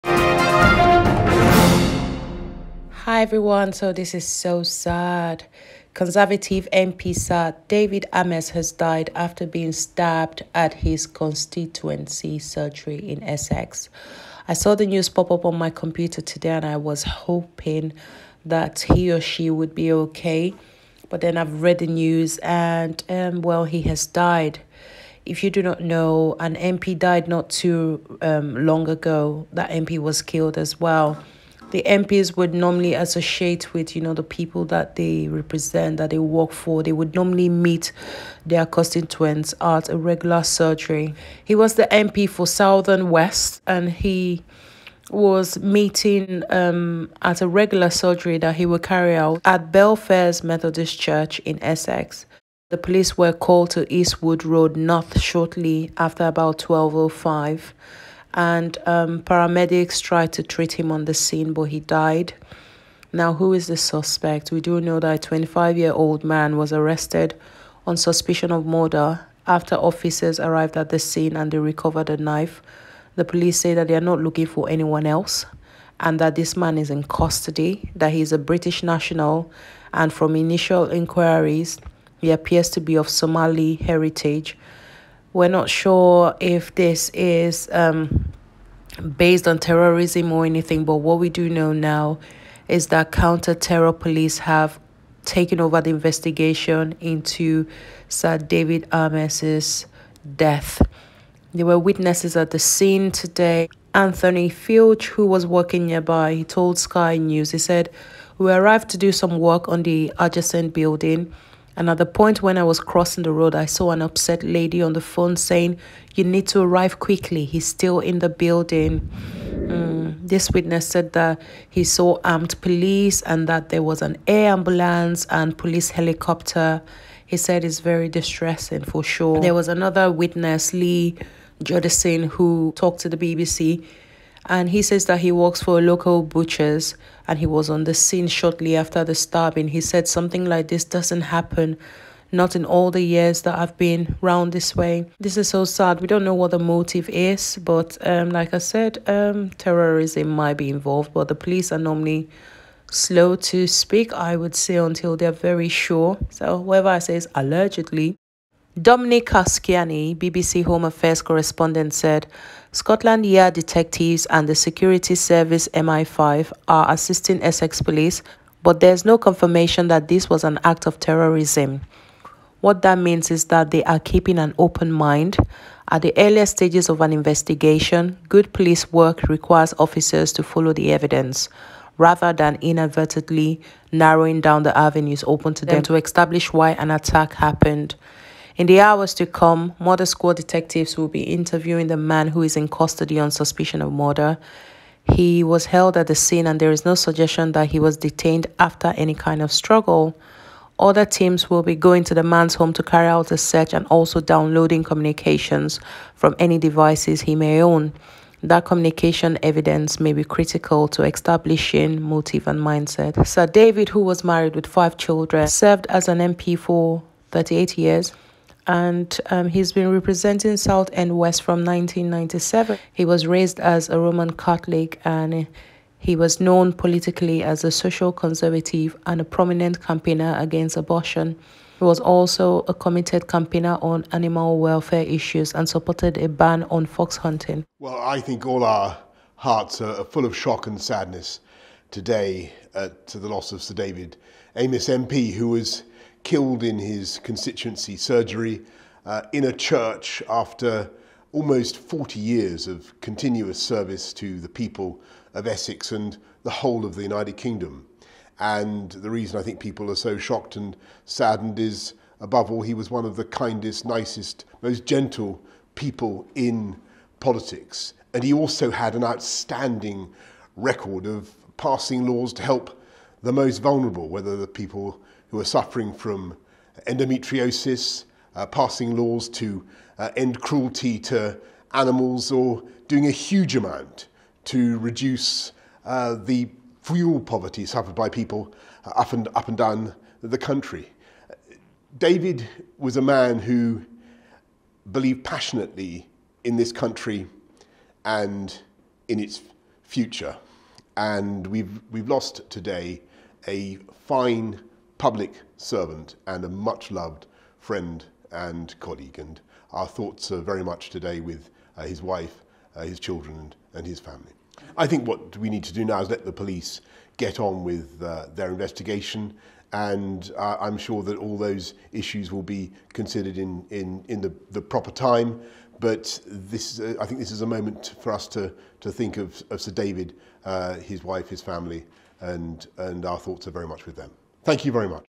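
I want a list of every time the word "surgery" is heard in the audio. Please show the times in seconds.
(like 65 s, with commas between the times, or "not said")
12 s, 40 s, 47 s, 247 s.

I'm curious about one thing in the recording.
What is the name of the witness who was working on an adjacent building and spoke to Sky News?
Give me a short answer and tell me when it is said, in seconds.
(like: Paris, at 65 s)
Anthony Filch, at 103 s.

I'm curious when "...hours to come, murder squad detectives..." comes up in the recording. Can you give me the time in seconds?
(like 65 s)
188 s.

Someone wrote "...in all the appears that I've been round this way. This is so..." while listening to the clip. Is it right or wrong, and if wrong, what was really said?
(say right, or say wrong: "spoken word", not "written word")
wrong: "years", not "appears".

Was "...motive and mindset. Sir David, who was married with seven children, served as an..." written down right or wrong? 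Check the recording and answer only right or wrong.
wrong.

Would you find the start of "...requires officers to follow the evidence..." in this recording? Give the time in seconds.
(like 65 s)
179 s.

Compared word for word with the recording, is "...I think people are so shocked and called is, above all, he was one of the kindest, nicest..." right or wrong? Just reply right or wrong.
wrong.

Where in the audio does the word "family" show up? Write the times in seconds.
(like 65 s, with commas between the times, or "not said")
313 s, 331 s.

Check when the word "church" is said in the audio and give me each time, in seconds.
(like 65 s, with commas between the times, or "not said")
50 s, 249 s.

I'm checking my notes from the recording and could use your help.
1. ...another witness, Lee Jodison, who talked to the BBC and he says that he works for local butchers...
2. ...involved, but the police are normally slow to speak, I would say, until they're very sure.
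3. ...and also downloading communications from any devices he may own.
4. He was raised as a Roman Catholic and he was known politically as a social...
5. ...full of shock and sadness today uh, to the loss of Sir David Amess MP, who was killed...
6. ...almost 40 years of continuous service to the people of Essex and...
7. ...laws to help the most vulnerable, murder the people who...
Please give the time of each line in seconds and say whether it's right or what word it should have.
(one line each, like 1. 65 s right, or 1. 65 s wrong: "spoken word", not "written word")
1. 129 s right
2. 150 s right
3. 203 s right
4. 222 s right
5. 240 s right
6. 251 s right
7. 272 s wrong: "whether", not "murder".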